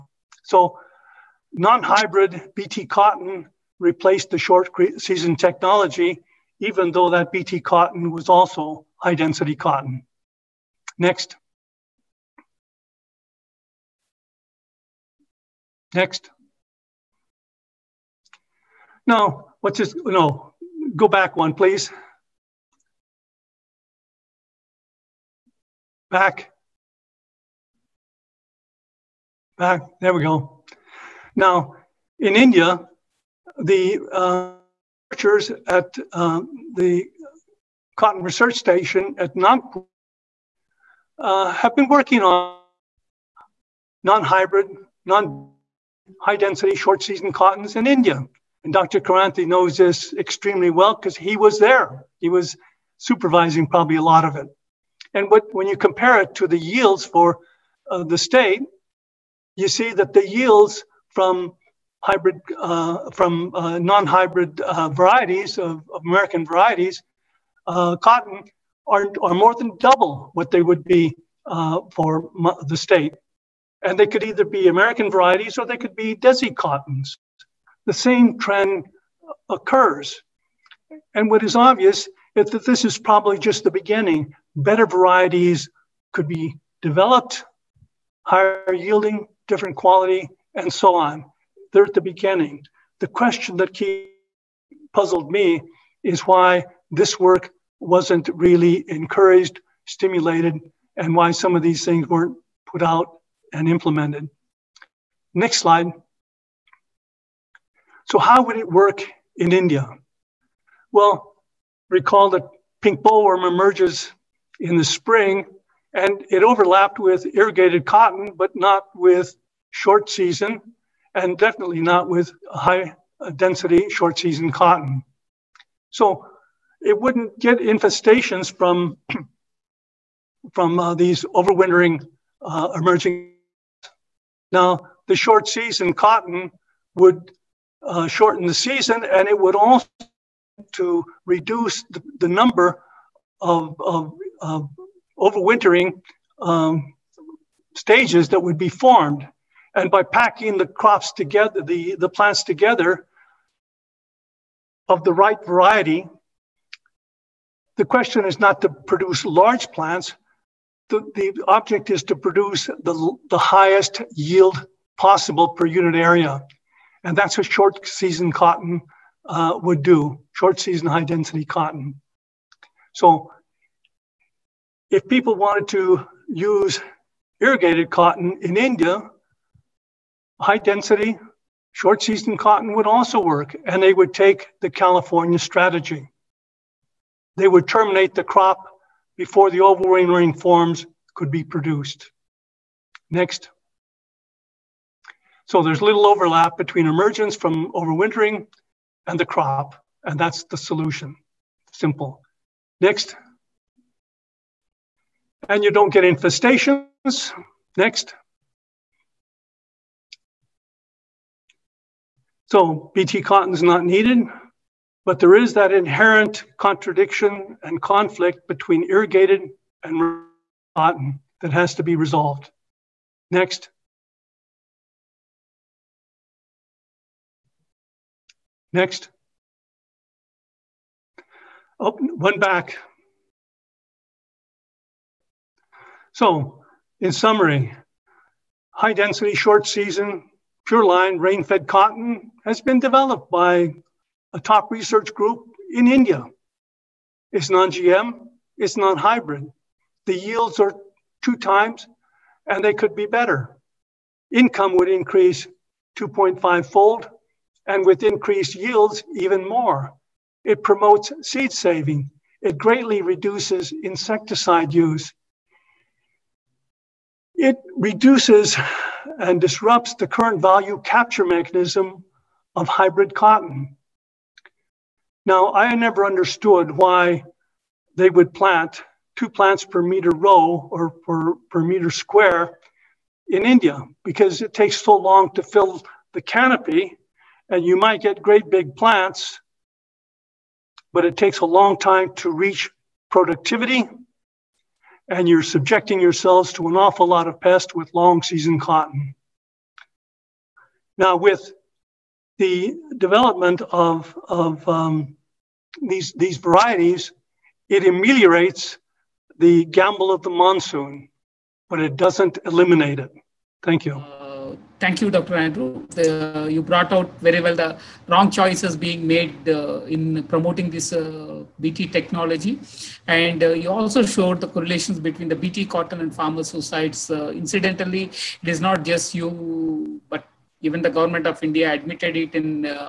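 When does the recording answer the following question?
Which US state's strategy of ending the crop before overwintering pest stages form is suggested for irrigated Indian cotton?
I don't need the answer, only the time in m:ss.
3:04.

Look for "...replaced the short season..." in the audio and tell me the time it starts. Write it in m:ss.
0:03.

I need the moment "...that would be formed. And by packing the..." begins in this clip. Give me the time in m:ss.
2:28.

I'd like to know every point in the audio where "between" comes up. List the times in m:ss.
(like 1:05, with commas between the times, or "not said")
3:16, 3:38, 5:24.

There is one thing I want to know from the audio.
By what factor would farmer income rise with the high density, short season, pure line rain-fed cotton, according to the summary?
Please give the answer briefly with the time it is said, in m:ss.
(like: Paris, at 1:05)
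2.5 fold, at 4:15.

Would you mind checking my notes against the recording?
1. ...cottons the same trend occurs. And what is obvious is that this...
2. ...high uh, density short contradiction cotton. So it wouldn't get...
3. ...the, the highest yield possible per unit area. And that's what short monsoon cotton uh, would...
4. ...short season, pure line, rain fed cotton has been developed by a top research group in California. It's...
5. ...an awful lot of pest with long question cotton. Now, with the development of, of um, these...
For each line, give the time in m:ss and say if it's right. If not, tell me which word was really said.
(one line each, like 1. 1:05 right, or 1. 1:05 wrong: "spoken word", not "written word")
1. 1:16 right
2. 2:02 wrong: "season", not "contradiction"
3. 2:42 wrong: "season", not "monsoon"
4. 3:59 wrong: "India", not "California"
5. 4:56 wrong: "season", not "question".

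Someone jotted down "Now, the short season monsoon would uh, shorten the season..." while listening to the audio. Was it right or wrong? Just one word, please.
wrong.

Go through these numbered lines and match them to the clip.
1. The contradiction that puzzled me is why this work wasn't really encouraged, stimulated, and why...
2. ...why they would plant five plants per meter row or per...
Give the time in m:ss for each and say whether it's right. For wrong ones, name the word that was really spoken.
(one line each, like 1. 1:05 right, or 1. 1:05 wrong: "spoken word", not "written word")
1. 1:32 wrong: "question", not "contradiction"
2. 4:36 wrong: "two", not "five".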